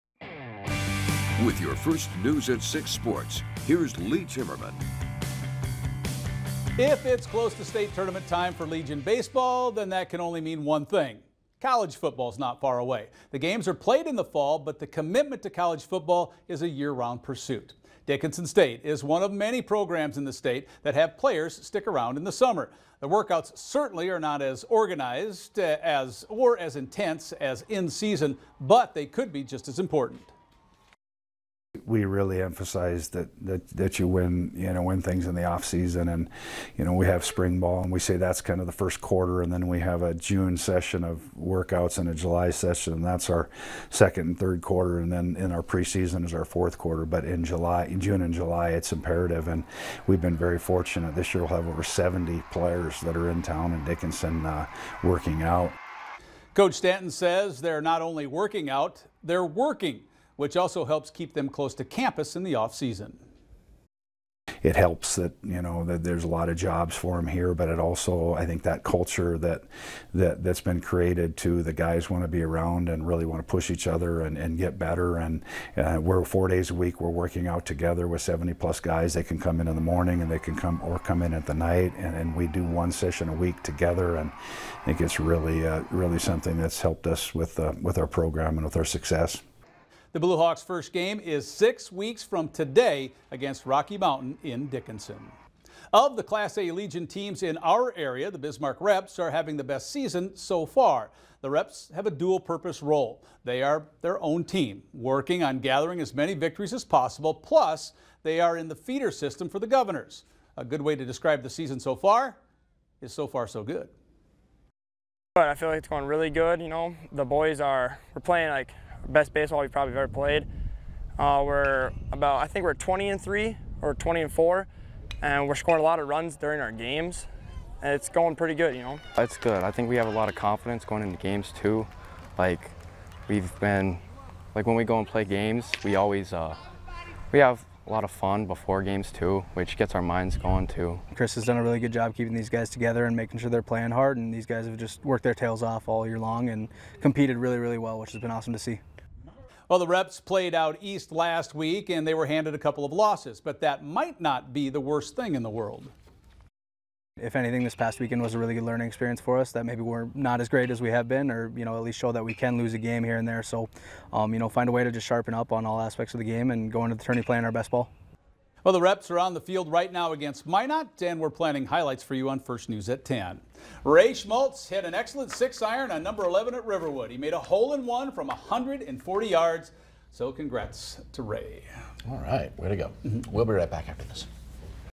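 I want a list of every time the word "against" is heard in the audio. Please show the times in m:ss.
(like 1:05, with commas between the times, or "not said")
1:33, 2:50.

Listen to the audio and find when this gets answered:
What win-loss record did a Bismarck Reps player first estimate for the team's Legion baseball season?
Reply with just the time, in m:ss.
2:02.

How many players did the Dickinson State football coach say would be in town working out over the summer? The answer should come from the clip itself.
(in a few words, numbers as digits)
over 70.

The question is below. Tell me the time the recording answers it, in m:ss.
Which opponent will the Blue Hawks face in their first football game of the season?
1:33.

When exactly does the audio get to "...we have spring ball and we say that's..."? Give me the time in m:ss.
0:36.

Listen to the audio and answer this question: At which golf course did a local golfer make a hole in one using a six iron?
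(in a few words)
Riverwood.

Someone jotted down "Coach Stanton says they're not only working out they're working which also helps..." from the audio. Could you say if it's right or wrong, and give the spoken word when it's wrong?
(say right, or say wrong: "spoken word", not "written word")
right.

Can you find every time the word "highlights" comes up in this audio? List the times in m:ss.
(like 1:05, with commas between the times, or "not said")
2:51.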